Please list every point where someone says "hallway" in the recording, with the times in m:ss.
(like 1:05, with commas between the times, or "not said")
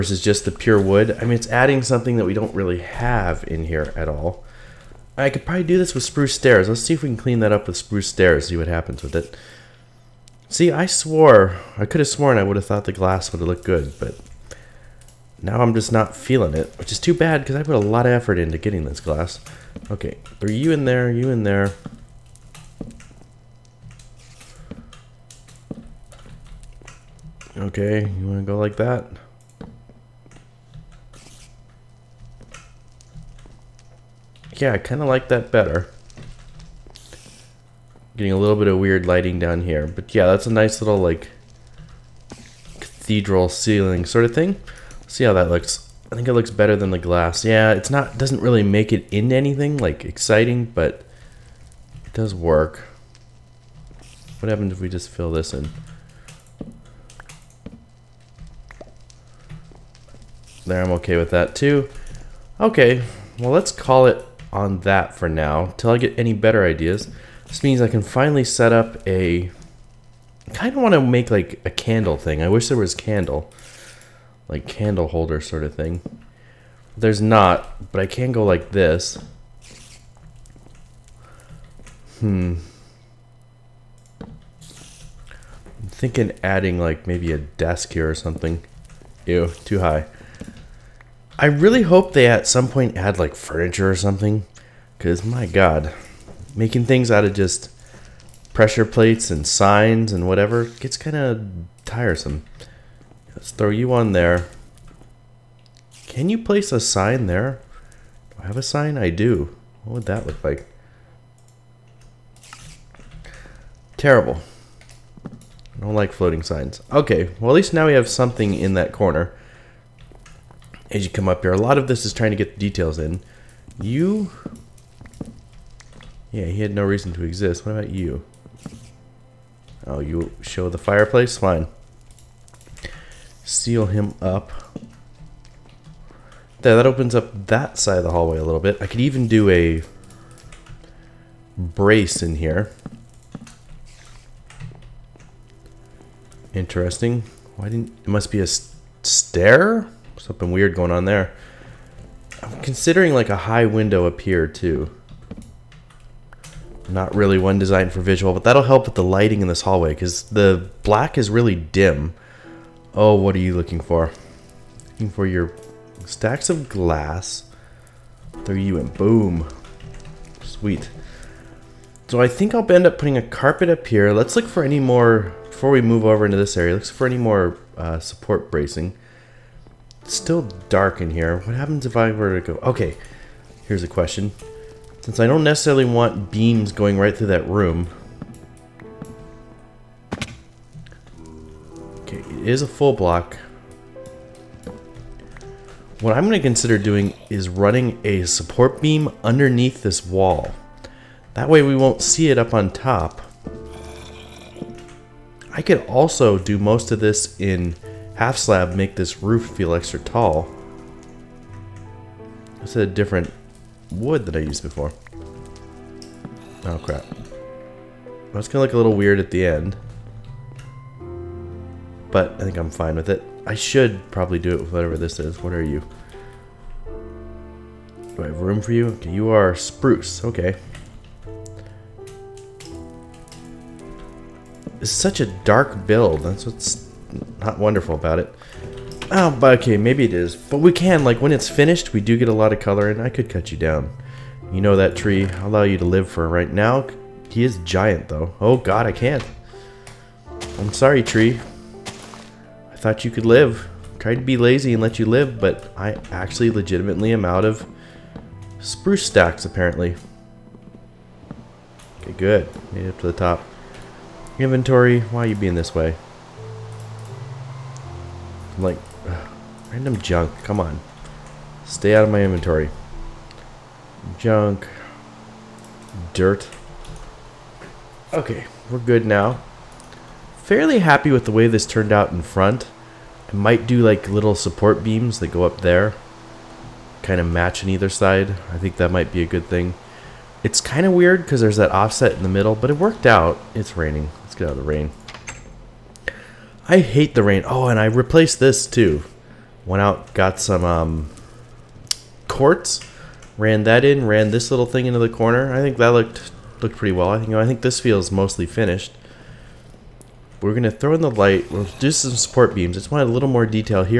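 2:18, 2:39.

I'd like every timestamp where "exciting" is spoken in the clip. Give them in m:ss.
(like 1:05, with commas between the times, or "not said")
0:50.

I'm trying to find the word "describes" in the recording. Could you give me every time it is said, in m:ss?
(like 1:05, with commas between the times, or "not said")
not said.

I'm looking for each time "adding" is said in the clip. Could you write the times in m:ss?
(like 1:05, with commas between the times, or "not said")
0:01, 1:26.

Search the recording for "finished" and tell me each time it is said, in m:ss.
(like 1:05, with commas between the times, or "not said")
4:01, 5:08.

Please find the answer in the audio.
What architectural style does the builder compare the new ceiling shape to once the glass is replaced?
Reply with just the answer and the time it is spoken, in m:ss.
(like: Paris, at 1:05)
Cathedral ceiling, at 0:42.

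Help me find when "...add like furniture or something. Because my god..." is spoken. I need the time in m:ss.
1:32.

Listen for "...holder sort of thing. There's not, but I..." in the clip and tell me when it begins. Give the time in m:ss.
1:15.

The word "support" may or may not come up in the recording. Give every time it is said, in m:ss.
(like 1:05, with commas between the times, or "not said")
2:58, 3:18, 4:44, 5:12.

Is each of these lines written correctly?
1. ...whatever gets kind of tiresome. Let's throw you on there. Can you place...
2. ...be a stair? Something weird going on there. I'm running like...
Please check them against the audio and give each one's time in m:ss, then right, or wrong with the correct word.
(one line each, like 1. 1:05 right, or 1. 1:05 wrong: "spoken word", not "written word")
1. 1:40 right
2. 2:28 wrong: "considering", not "running".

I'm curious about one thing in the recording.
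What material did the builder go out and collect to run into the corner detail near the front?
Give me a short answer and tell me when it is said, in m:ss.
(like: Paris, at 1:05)
Quartz, at 5:02.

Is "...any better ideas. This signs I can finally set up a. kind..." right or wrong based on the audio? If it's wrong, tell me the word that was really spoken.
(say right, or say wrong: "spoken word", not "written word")
wrong: "means", not "signs".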